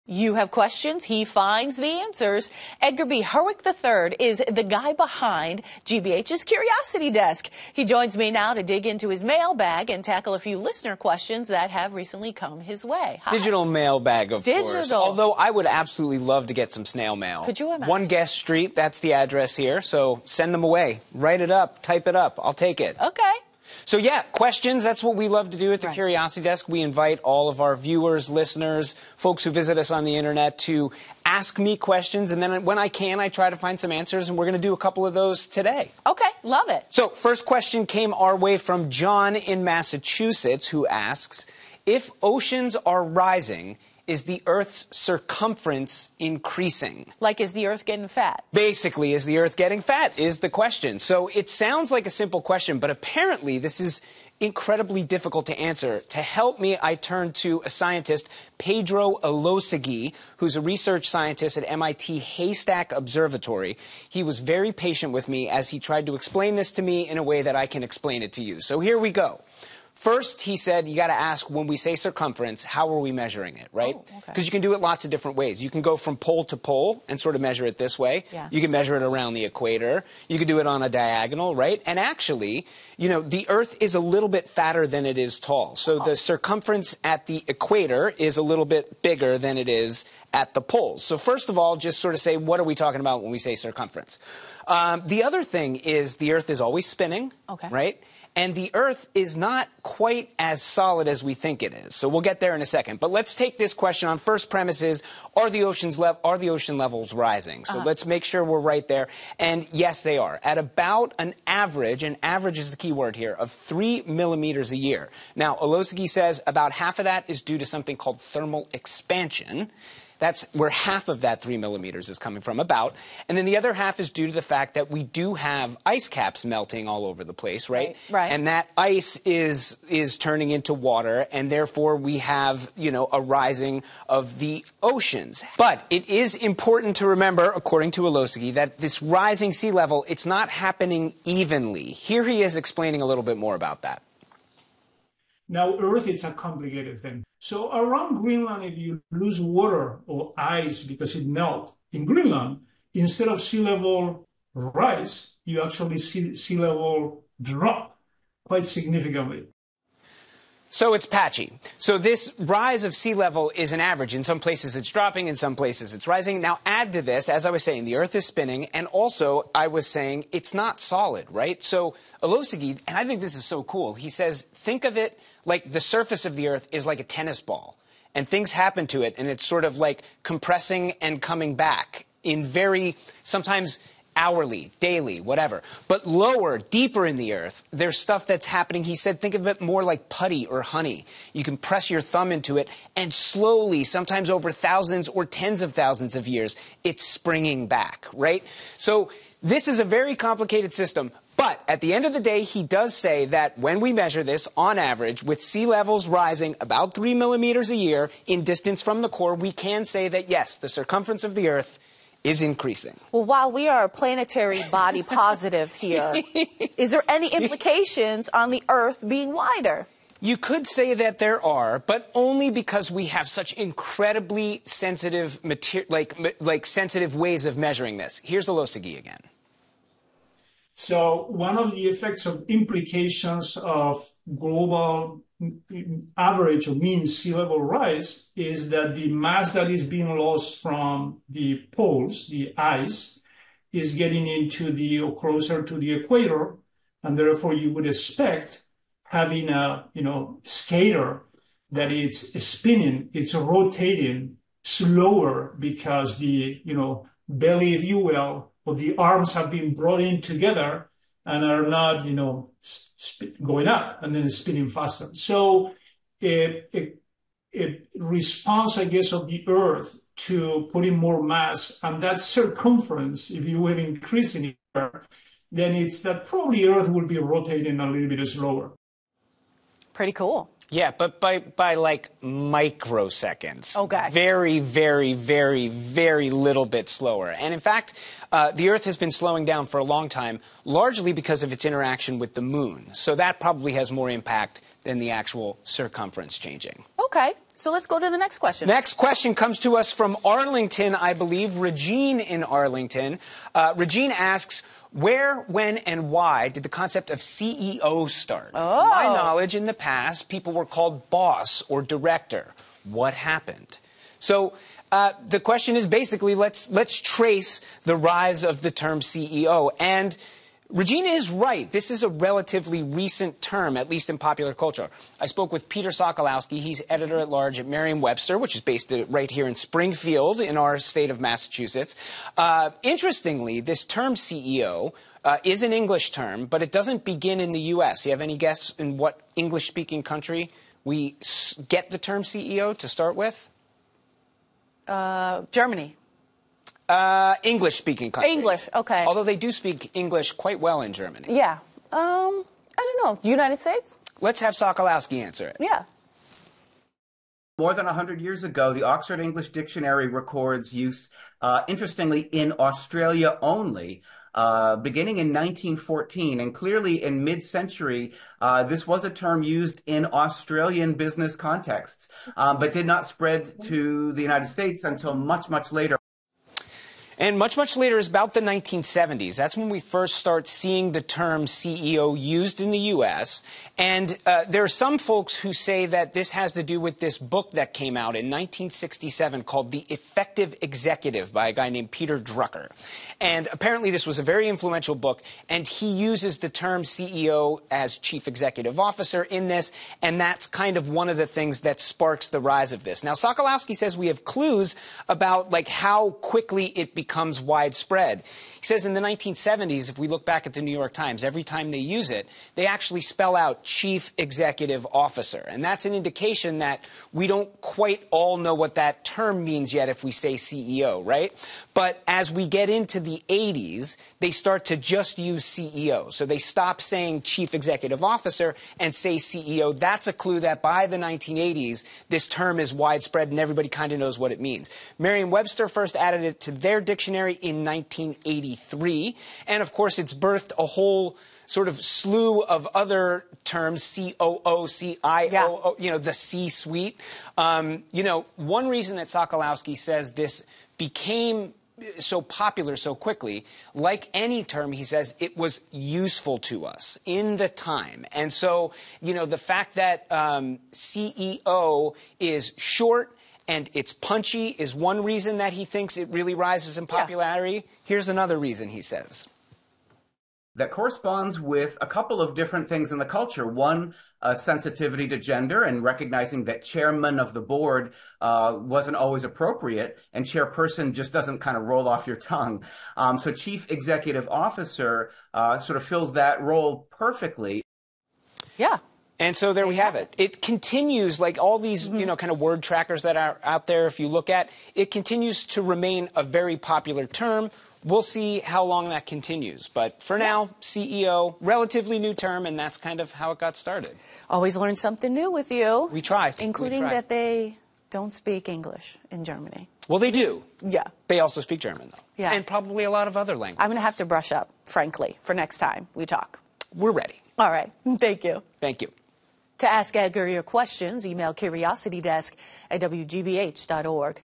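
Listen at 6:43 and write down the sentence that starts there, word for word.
Now, Sokolowski says we have clues about like how quickly it becomes becomes widespread.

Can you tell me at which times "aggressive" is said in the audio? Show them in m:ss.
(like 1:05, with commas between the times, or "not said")
not said.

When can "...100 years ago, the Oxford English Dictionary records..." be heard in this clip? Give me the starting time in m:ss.
5:57.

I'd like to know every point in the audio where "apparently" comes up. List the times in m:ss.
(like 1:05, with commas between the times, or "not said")
0:52, 6:33.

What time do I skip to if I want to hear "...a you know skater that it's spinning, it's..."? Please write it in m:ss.
4:09.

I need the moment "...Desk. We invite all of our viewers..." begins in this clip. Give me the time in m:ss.
0:26.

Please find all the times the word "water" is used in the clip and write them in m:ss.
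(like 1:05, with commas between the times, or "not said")
2:10, 2:29.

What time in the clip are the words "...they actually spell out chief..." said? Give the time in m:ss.
6:52.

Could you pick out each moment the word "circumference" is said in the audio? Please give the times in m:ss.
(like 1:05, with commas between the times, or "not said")
0:44, 1:11, 1:26, 1:33, 3:30, 4:32, 4:55.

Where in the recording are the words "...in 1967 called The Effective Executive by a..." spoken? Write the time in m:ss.
6:28.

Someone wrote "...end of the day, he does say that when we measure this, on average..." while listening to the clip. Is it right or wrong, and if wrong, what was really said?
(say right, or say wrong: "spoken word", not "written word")
right.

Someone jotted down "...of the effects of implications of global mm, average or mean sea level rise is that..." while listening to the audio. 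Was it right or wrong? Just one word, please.
right.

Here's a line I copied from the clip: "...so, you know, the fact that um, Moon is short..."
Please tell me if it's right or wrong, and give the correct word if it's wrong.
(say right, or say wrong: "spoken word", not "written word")
wrong: "CEO", not "Moon".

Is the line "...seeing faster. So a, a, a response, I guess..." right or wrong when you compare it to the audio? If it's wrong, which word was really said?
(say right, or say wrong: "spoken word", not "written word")
wrong: "spinning", not "seeing".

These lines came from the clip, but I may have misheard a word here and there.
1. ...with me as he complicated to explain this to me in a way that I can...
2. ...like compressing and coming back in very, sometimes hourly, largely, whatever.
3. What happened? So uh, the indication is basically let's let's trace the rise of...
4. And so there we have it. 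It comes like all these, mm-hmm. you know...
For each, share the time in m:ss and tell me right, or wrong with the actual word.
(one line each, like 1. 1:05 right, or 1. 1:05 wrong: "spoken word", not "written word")
1. 1:05 wrong: "tried", not "complicated"
2. 2:59 wrong: "daily", not "largely"
3. 5:12 wrong: "question", not "indication"
4. 8:09 wrong: "continues", not "comes".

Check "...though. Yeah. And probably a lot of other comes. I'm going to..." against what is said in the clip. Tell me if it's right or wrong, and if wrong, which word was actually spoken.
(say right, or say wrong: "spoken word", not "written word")
wrong: "languages", not "comes".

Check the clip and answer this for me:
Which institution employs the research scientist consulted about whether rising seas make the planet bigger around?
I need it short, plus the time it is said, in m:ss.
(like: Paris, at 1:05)
MIT Haystack Observatory, at 1:01.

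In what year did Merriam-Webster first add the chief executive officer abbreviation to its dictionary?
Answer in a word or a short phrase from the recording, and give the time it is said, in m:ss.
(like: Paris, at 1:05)
1983, at 7:17.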